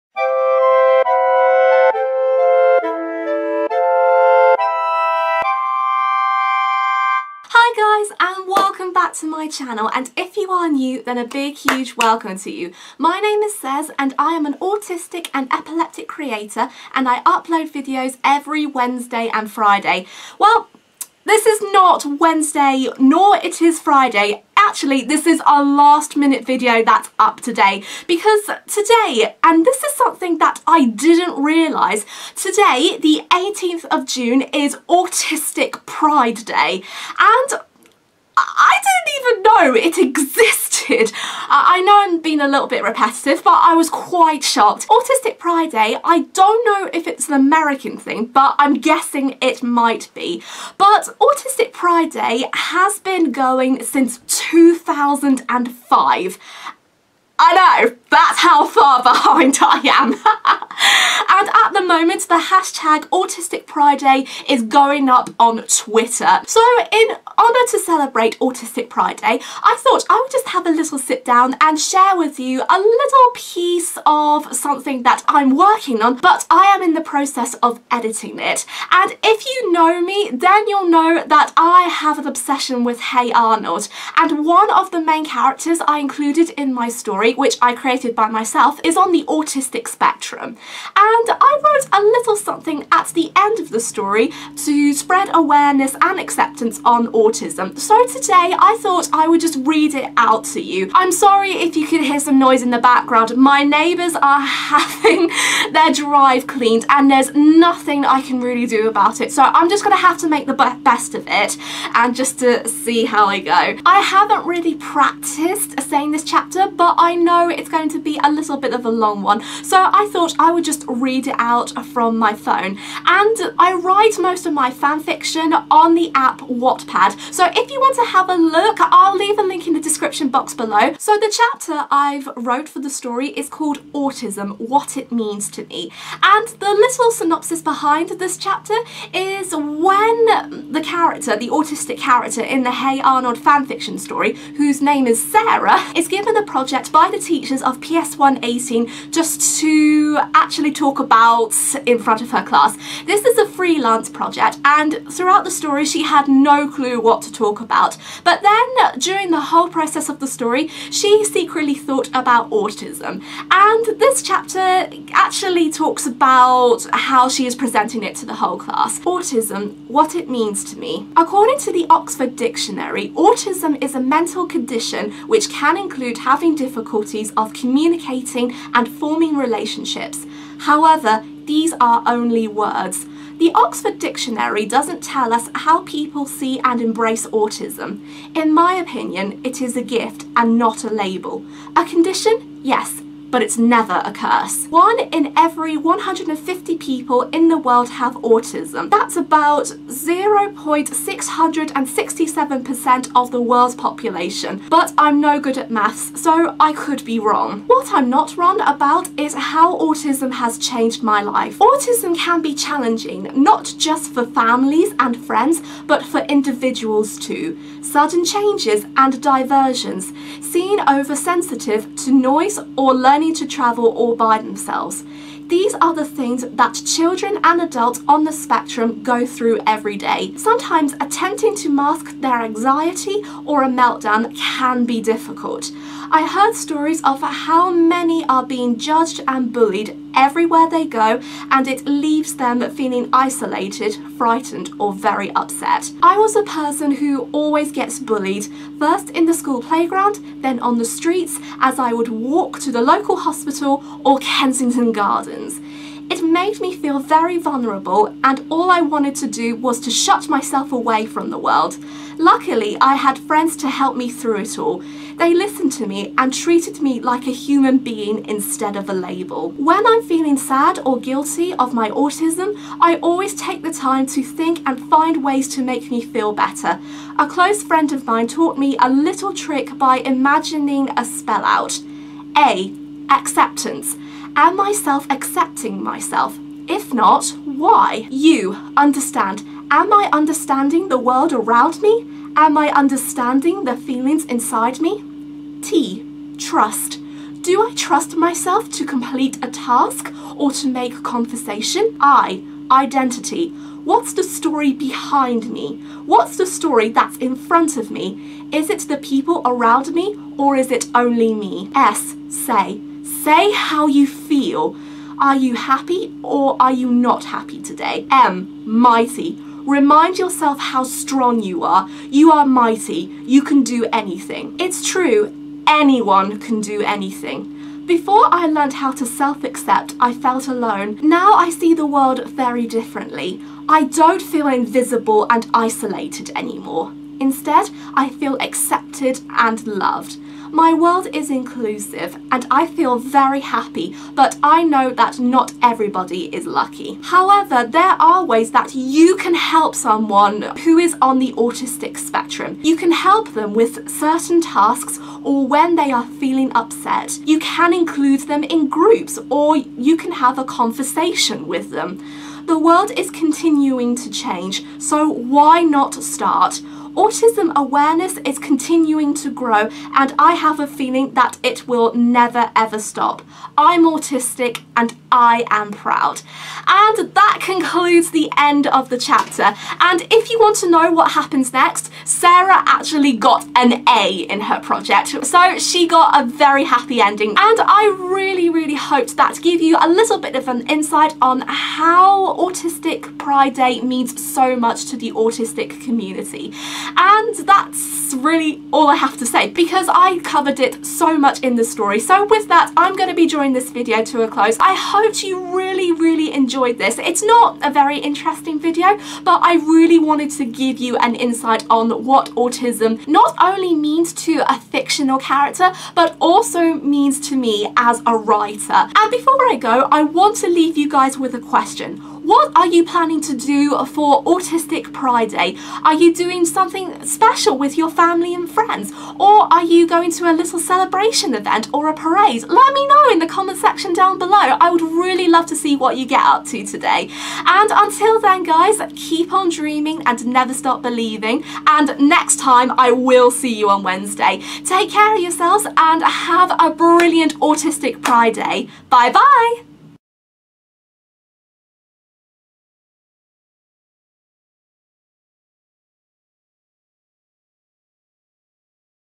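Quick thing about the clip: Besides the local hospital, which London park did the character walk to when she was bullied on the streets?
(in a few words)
Kensington Gardens.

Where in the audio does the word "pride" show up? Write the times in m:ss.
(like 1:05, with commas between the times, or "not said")
0:35, 0:45, 0:51, 1:03, 1:08, 6:33, 7:04, 7:28.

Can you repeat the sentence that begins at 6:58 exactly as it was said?
And before I go, I want to leave you guys with a question.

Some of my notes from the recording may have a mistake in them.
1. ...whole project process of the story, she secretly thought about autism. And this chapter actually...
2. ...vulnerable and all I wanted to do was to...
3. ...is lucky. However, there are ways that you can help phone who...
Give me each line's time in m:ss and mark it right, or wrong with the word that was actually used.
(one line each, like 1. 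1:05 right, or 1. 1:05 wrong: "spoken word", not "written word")
1. 2:39 right
2. 4:17 right
3. 5:46 wrong: "someone", not "phone".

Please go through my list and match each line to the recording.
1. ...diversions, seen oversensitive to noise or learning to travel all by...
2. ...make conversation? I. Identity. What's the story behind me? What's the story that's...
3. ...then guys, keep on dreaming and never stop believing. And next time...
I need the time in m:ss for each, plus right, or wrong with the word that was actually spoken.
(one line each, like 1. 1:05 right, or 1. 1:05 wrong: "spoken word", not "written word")
1. 3:39 right
2. 5:00 right
3. 7:18 right.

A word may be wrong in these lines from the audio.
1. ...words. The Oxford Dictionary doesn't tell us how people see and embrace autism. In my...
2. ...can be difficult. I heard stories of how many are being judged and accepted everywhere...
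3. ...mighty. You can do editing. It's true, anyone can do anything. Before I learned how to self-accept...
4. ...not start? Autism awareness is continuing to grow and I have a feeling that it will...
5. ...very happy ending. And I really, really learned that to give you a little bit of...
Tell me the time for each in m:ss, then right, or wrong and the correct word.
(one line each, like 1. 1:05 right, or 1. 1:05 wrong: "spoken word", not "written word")
1. 3:02 right
2. 3:54 wrong: "bullied", not "accepted"
3. 5:22 wrong: "anything", not "editing"
4. 6:05 right
5. 6:26 wrong: "hoped", not "learned".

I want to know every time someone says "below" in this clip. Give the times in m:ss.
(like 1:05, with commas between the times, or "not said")
2:10, 7:14.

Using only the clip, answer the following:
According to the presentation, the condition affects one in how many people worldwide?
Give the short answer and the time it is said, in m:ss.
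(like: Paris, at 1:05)
150, at 3:15.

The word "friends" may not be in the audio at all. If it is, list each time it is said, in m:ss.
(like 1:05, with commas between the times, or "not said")
3:35, 4:23, 4:37, 7:08.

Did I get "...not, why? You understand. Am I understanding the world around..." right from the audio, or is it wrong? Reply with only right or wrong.
right.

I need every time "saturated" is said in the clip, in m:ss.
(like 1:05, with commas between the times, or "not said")
not said.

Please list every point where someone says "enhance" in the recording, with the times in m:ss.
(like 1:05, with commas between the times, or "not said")
not said.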